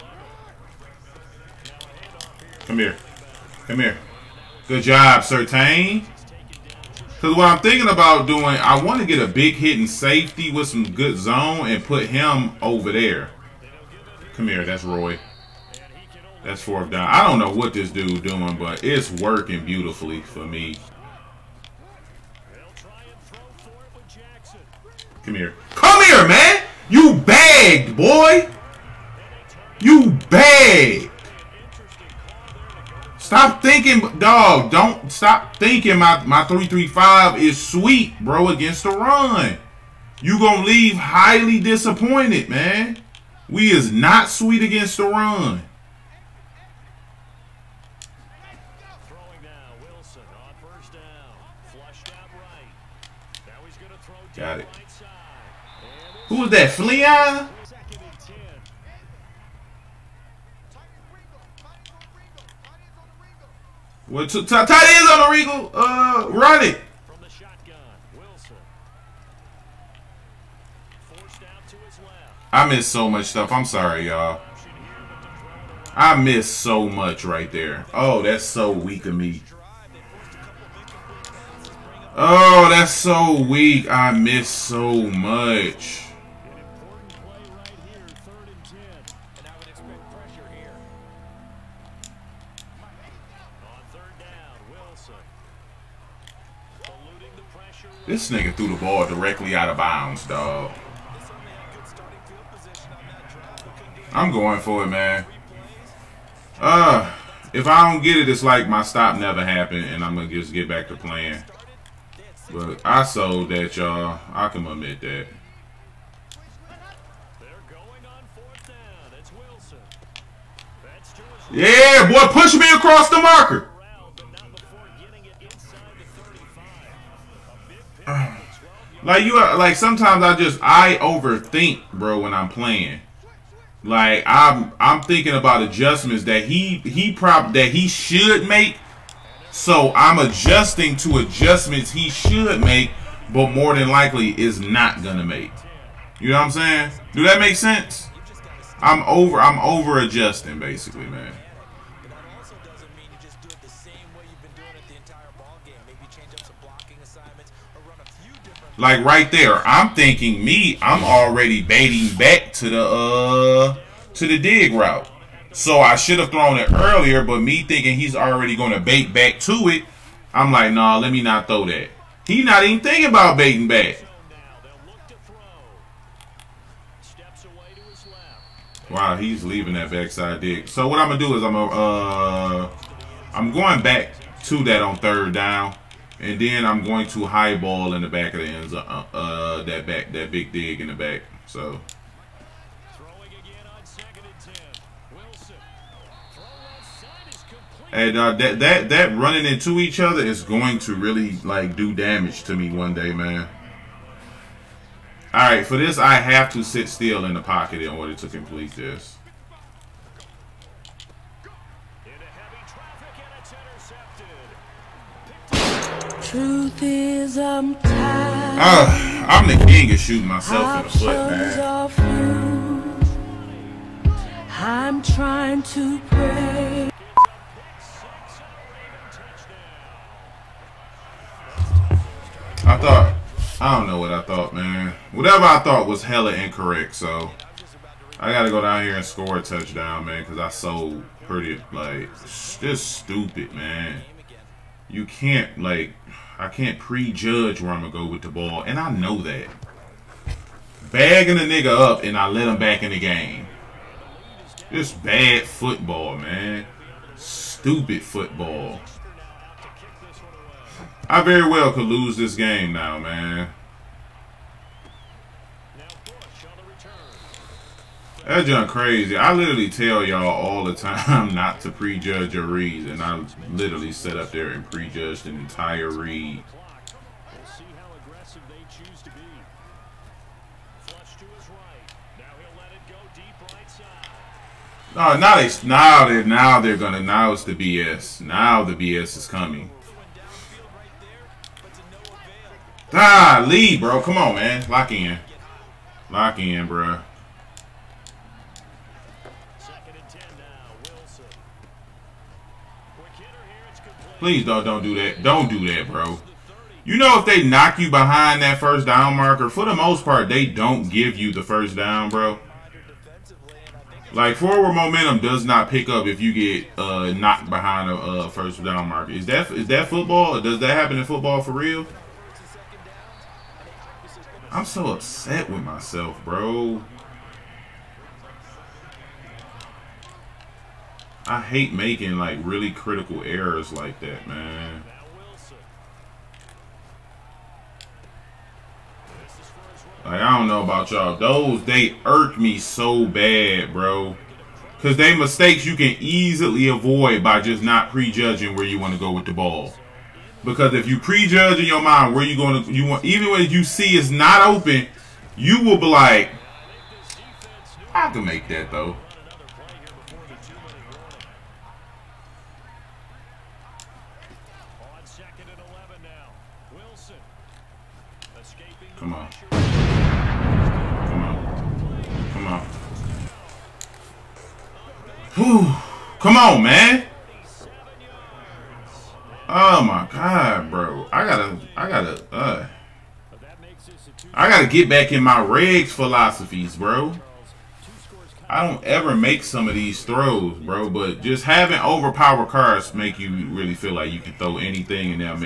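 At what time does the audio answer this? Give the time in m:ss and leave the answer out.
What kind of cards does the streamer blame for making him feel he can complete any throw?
6:31.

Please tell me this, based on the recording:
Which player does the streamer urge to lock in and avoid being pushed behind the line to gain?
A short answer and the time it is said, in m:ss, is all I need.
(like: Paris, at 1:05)
Lee, at 4:53.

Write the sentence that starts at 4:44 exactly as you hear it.
No, now they now they now they're gonna now it's the BS.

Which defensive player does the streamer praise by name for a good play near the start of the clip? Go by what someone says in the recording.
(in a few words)
Surtain.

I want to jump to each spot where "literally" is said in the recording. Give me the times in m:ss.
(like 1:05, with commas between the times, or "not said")
4:29, 4:33.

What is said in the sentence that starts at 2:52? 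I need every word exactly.
He not even thinking about baiting back.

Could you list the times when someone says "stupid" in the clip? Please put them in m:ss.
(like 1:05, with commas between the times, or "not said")
4:03, 4:17.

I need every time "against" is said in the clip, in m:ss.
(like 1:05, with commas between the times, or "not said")
0:38, 0:44.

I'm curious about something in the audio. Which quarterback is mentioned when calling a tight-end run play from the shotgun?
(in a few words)
Wilson.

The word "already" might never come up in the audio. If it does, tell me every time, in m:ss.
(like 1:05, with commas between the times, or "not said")
2:41, 2:48.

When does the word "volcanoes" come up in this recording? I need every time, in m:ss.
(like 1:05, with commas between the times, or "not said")
not said.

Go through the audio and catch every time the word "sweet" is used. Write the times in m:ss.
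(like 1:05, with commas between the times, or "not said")
0:37, 0:44.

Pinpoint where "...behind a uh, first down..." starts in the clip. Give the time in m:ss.
5:17.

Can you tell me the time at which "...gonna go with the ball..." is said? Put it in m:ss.
4:07.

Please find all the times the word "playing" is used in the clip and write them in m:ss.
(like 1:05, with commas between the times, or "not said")
1:50, 2:12.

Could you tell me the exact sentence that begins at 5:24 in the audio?
I'm so upset with myself, bro.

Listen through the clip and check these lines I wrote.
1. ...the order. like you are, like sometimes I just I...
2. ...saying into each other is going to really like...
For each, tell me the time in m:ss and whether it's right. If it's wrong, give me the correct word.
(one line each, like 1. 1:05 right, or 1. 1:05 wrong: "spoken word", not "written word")
1. 2:03 wrong: "marker", not "order"
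2. 3:19 wrong: "running", not "saying".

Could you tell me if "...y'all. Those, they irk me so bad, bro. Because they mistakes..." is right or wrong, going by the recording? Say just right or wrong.
right.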